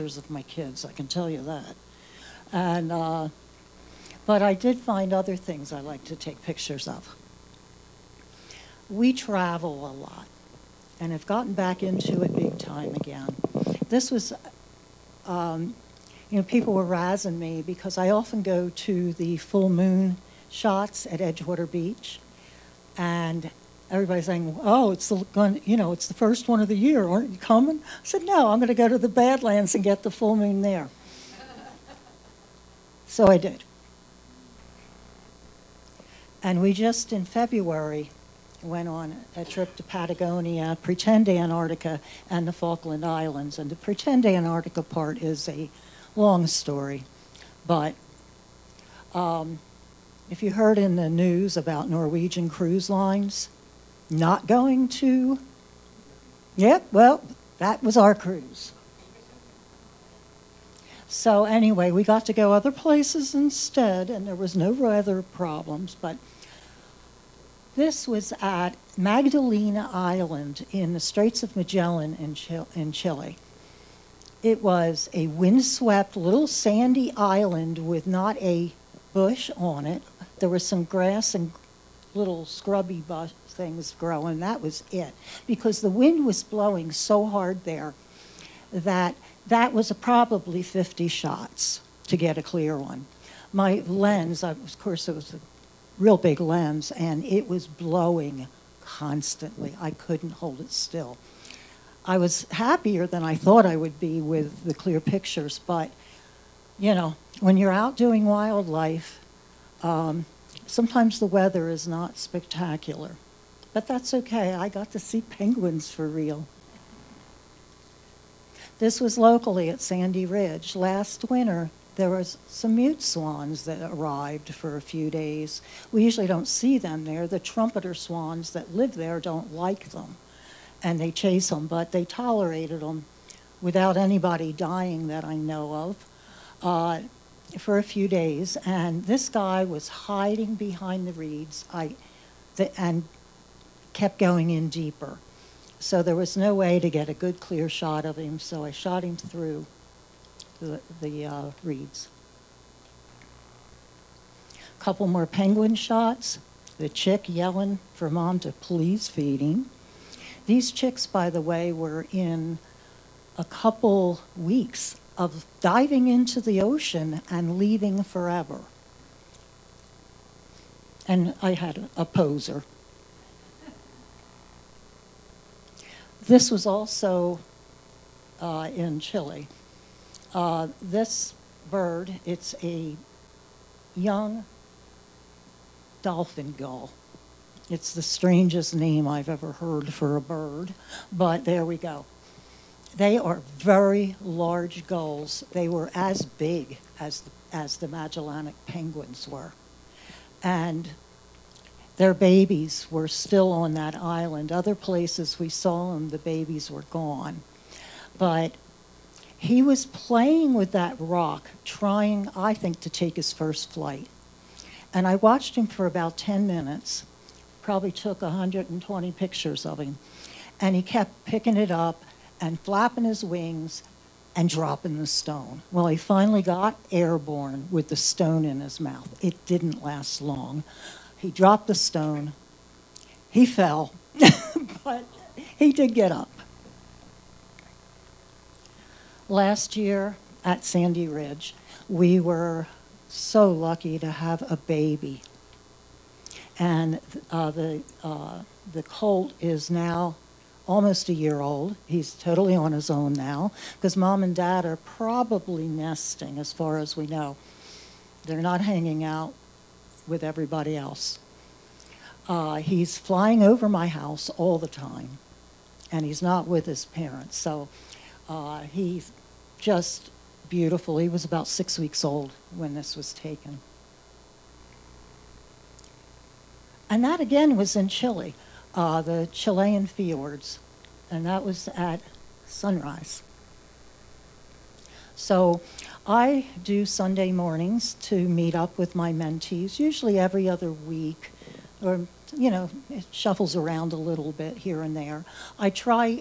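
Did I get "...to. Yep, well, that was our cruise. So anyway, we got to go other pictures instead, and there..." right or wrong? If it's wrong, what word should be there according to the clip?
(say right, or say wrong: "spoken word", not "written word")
wrong: "places", not "pictures".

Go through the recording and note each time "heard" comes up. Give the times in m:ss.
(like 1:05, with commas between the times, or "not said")
0:50, 3:09.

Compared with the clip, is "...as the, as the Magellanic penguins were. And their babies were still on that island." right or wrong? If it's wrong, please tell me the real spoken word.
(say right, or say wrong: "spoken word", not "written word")
right.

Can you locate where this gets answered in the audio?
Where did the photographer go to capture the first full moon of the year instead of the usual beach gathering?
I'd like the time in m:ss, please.
0:28.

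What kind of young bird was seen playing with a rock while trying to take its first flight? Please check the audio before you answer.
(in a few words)
dolphin gull.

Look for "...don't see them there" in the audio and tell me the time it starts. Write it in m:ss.
2:06.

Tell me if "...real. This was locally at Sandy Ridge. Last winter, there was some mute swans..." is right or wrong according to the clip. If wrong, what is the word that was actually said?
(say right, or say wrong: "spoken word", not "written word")
right.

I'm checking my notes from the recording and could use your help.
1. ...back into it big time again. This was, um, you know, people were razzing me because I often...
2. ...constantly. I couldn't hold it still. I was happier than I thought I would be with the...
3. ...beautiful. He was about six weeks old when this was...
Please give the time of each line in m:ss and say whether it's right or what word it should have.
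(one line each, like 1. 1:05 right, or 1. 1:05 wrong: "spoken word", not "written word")
1. 0:11 right
2. 1:38 right
3. 4:30 right.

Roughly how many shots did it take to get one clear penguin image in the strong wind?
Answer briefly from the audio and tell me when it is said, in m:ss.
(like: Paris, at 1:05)
50, at 1:30.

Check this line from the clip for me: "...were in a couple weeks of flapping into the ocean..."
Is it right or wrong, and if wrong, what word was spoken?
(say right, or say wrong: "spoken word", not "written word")
wrong: "diving", not "flapping".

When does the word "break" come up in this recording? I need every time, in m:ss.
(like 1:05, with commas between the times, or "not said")
not said.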